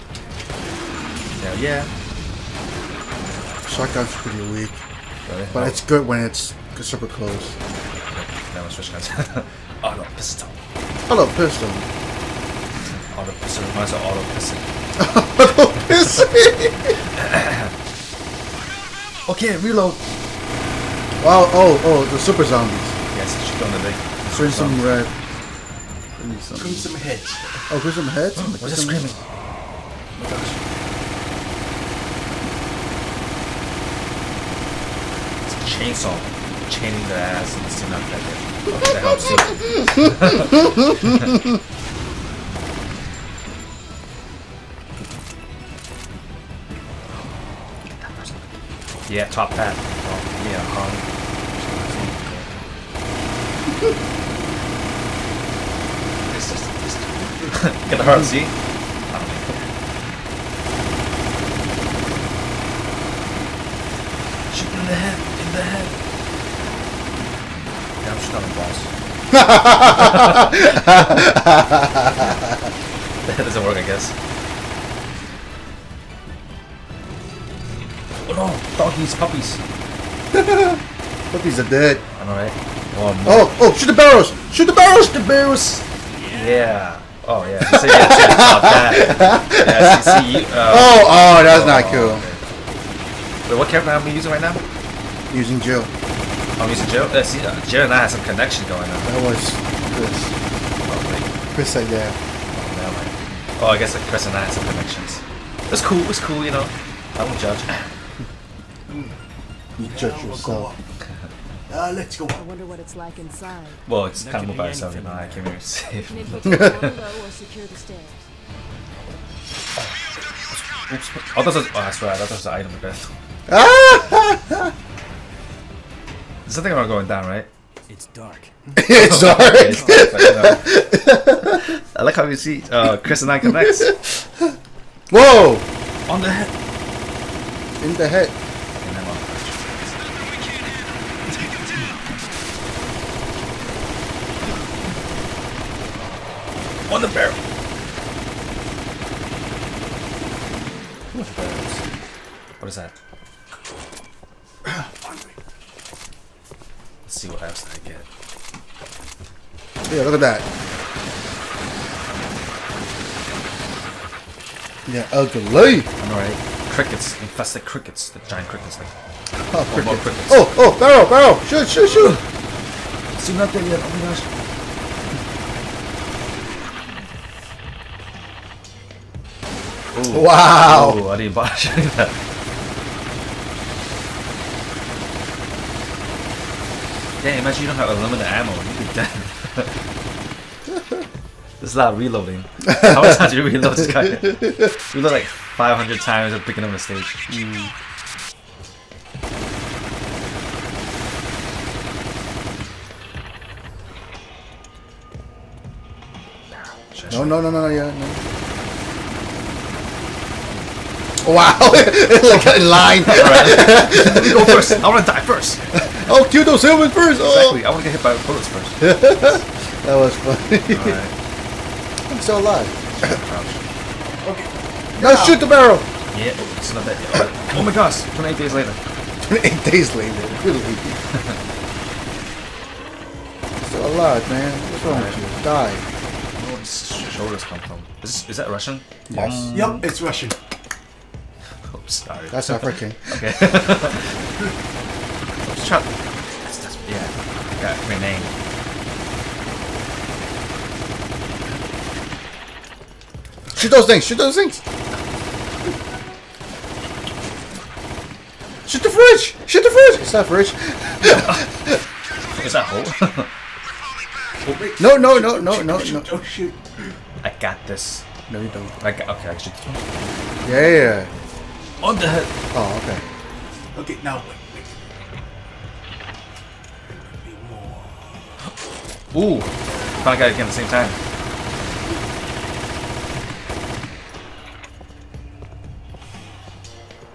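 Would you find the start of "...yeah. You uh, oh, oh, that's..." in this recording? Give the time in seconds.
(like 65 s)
87 s.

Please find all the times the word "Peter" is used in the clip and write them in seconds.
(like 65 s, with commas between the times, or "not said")
not said.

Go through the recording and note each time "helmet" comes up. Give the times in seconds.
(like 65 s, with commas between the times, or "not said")
not said.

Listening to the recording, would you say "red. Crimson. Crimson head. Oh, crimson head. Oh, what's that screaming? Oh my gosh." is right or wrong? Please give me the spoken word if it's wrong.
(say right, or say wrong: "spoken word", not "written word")
right.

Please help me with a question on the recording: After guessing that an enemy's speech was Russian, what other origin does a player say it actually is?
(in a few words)
African.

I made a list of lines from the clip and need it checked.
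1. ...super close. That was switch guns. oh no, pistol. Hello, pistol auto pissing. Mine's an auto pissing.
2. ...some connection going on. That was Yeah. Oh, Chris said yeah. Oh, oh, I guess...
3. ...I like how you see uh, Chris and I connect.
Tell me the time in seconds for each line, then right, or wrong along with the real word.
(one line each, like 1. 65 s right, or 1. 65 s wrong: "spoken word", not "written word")
1. 6 s right
2. 98 s wrong: "Chris", not "Yeah"
3. 131 s right.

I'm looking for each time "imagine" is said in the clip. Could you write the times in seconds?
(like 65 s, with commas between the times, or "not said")
187 s.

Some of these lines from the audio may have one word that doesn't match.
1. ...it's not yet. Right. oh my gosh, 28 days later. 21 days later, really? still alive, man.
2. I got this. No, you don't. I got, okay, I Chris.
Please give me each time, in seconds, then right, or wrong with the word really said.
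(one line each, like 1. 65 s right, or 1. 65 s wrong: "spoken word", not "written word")
1. 226 s wrong: "28", not "21"
2. 267 s wrong: "Yeah", not "Chris".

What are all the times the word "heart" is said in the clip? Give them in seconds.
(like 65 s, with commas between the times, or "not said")
58 s.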